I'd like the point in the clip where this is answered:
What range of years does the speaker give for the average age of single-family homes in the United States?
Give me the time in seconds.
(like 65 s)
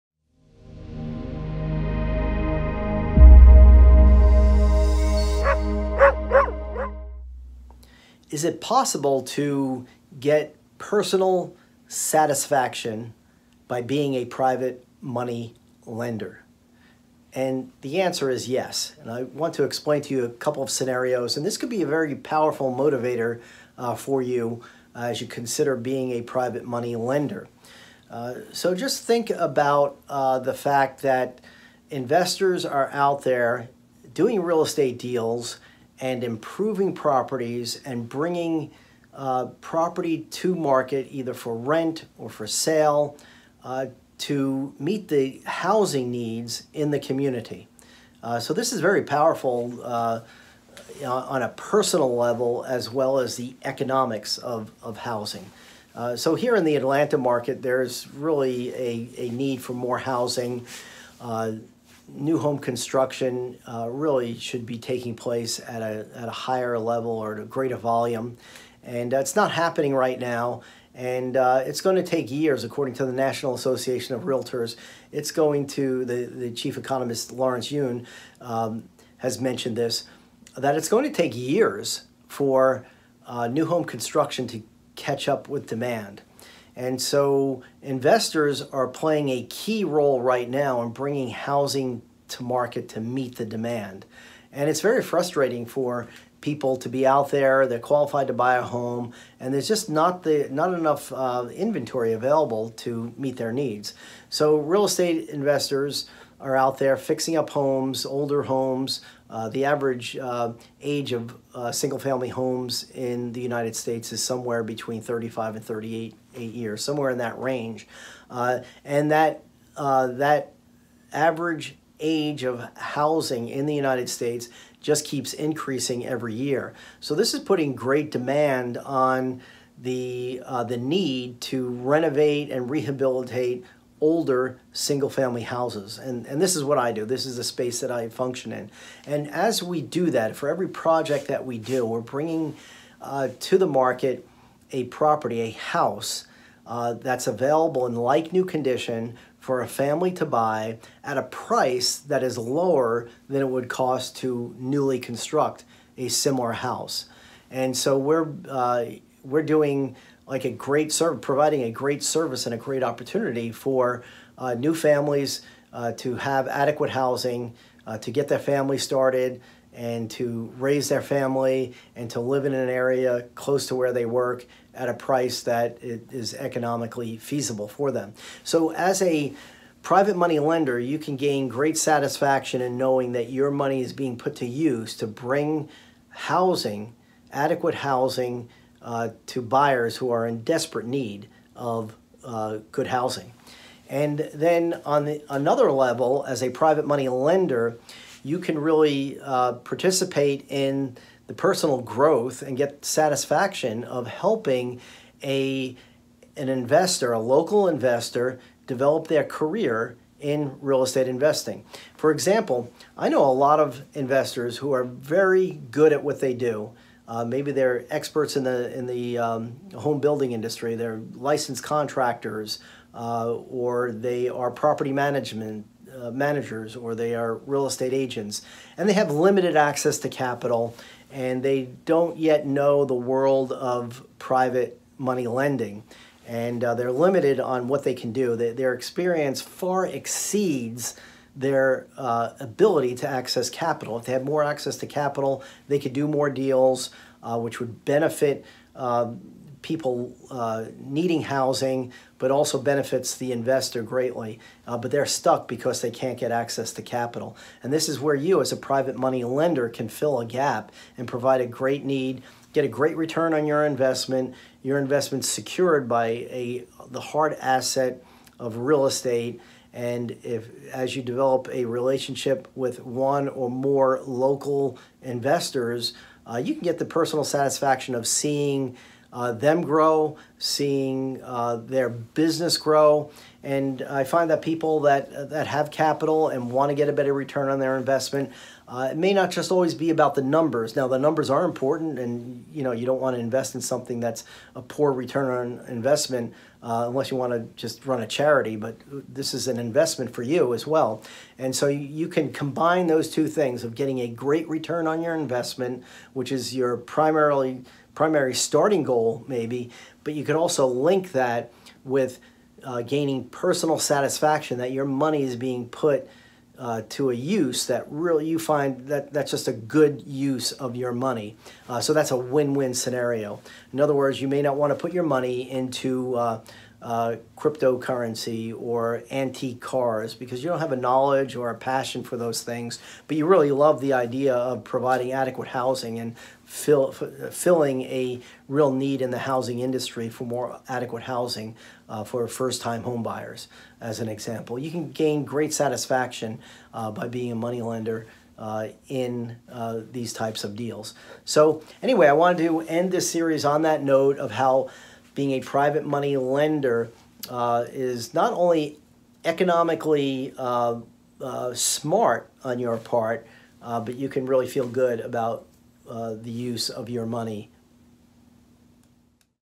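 114 s.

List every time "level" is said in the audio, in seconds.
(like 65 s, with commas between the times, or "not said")
52 s, 66 s, 195 s.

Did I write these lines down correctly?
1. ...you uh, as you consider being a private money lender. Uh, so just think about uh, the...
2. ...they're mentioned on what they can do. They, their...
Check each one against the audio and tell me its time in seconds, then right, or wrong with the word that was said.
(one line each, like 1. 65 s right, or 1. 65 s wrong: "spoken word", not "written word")
1. 24 s right
2. 236 s wrong: "limited", not "mentioned".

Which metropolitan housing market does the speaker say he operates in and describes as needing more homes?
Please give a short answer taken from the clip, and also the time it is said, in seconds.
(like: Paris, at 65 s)
Atlanta, at 56 s.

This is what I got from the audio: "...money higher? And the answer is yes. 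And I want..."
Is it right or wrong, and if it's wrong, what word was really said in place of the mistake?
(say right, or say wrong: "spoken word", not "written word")
wrong: "lender", not "higher".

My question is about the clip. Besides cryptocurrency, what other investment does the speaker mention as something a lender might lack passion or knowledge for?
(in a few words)
Antique cars.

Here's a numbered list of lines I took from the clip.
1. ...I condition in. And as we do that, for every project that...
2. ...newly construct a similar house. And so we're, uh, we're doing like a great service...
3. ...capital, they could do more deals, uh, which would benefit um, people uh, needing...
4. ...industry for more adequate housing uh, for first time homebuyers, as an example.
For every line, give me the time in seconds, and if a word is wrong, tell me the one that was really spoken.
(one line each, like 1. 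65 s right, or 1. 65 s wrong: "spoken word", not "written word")
1. 137 s wrong: "function", not "condition"
2. 154 s right
3. 244 s right
4. 339 s right.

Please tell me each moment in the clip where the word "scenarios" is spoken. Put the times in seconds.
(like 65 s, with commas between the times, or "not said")
20 s, 322 s.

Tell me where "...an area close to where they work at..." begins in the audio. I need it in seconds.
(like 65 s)
172 s.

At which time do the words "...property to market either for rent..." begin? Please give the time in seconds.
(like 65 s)
39 s.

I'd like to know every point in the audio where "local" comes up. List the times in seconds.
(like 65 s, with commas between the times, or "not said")
207 s, 274 s.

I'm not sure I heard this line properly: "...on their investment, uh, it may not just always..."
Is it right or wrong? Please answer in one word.
right.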